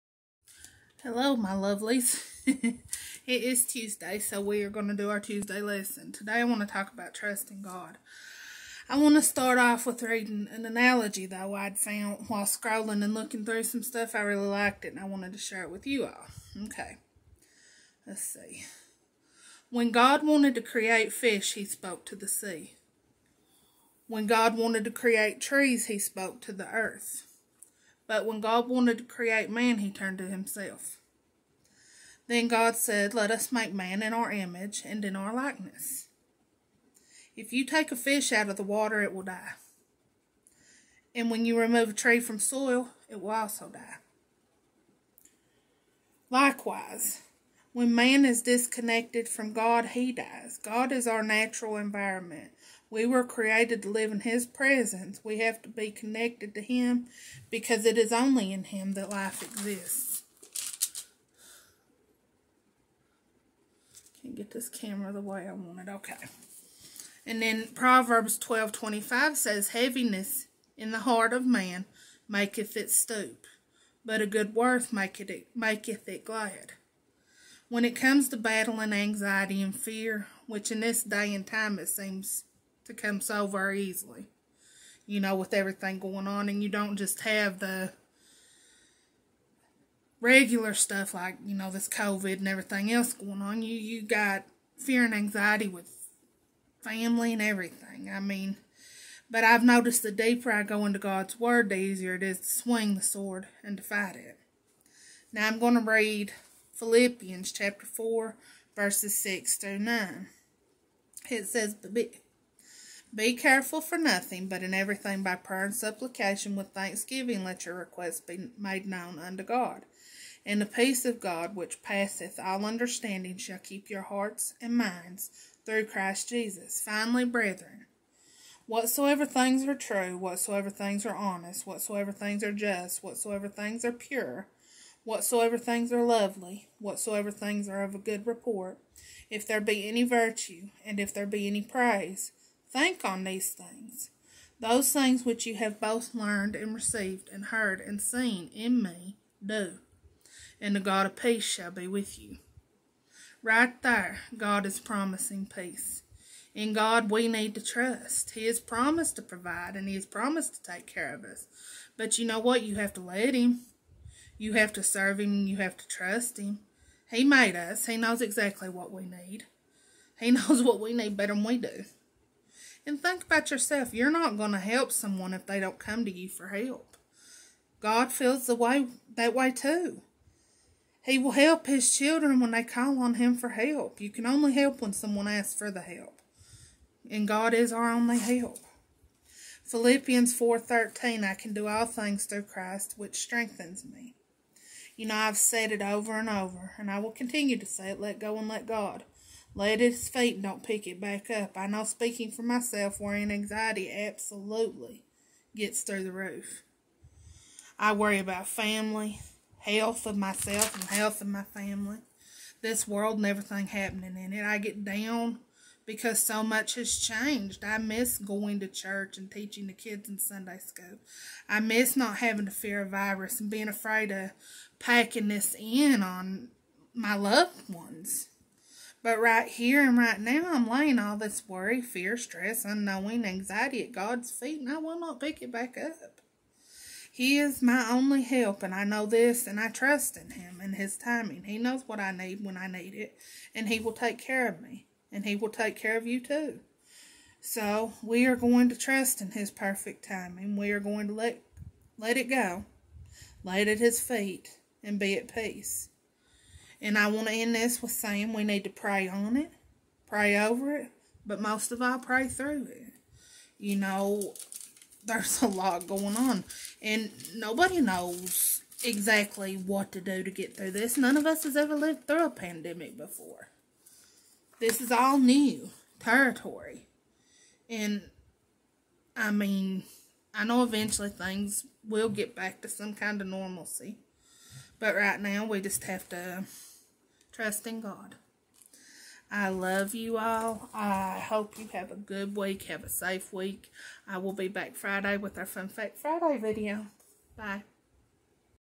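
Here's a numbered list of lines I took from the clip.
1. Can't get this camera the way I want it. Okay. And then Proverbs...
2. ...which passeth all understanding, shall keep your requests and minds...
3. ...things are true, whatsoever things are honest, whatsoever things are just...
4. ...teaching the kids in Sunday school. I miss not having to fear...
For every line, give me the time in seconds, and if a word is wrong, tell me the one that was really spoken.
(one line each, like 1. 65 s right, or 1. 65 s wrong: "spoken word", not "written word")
1. 64 s right
2. 121 s wrong: "hearts", not "requests"
3. 129 s right
4. 219 s right.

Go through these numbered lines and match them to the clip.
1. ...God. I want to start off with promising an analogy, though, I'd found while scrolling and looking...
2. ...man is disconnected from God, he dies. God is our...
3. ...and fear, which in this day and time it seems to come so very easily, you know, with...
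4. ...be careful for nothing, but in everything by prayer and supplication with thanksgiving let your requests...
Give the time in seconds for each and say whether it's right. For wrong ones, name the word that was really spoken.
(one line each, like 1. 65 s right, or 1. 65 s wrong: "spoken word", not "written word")
1. 7 s wrong: "reading", not "promising"
2. 47 s right
3. 79 s right
4. 113 s right.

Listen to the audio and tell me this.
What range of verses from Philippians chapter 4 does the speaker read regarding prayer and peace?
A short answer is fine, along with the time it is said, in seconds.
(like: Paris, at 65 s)
6 through 9, at 109 s.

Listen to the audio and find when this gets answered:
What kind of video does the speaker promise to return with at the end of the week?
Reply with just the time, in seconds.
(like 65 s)
295 s.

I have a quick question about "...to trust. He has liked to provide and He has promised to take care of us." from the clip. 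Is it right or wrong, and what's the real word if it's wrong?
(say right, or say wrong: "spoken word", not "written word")
wrong: "promised", not "liked".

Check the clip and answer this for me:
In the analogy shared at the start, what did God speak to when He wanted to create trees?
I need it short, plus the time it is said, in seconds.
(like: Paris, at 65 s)
The earth, at 26 s.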